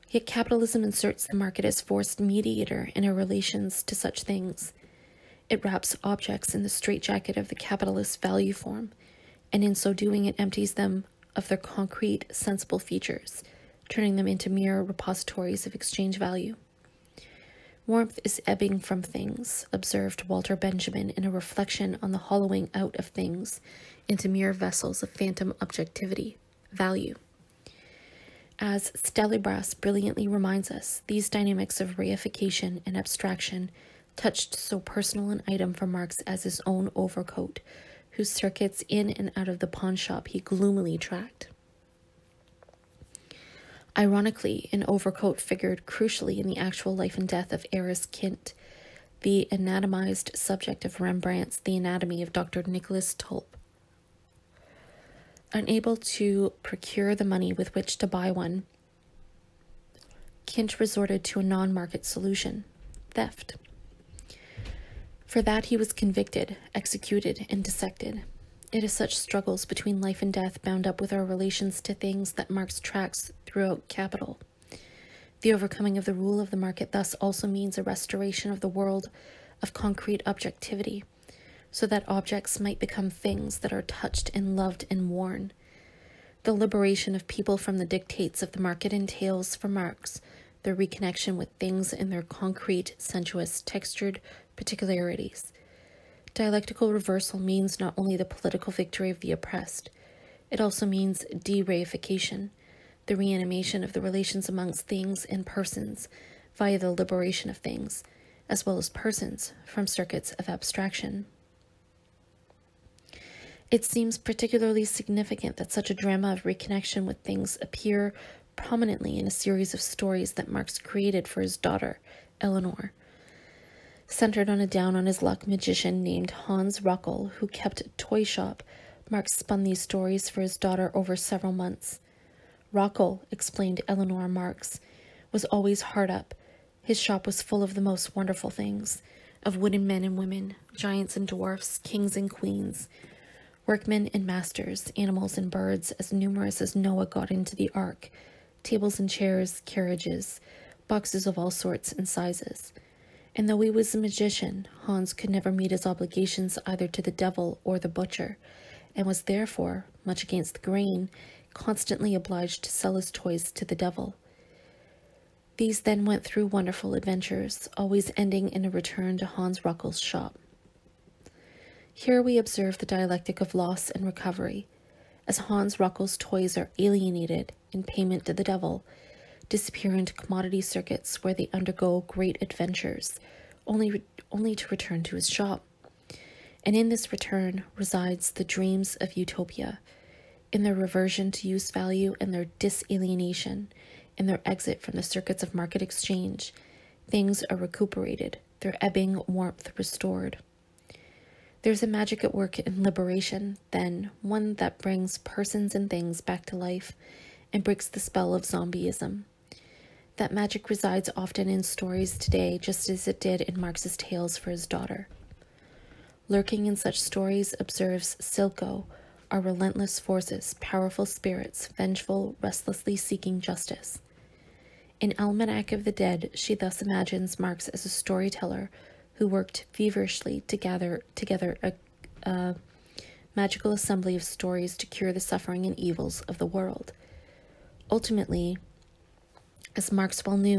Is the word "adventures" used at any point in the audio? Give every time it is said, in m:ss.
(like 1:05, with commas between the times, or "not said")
2:46, 3:02.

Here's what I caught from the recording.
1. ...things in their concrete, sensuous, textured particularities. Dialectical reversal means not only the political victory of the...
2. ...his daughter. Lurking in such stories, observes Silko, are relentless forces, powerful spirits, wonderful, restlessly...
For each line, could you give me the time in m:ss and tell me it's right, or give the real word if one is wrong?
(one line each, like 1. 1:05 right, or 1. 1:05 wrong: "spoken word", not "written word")
1. 1:31 right
2. 3:34 wrong: "vengeful", not "wonderful".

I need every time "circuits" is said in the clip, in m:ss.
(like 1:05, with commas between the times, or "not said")
0:38, 1:49, 3:00, 3:15.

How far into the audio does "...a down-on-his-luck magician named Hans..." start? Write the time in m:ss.
2:04.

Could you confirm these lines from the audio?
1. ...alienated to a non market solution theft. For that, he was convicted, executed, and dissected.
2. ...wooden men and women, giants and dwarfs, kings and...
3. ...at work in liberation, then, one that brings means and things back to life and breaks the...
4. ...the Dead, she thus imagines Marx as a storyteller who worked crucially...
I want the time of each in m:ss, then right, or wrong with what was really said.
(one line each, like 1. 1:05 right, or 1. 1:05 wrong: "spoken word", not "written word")
1. 1:00 wrong: "resorted", not "alienated"
2. 2:19 right
3. 3:22 wrong: "persons", not "means"
4. 3:45 wrong: "feverishly", not "crucially".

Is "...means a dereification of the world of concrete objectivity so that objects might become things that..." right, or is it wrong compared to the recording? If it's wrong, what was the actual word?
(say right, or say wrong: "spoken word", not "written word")
wrong: "restoration", not "dereification".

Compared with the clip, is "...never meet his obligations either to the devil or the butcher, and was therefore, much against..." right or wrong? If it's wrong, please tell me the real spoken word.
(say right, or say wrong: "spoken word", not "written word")
right.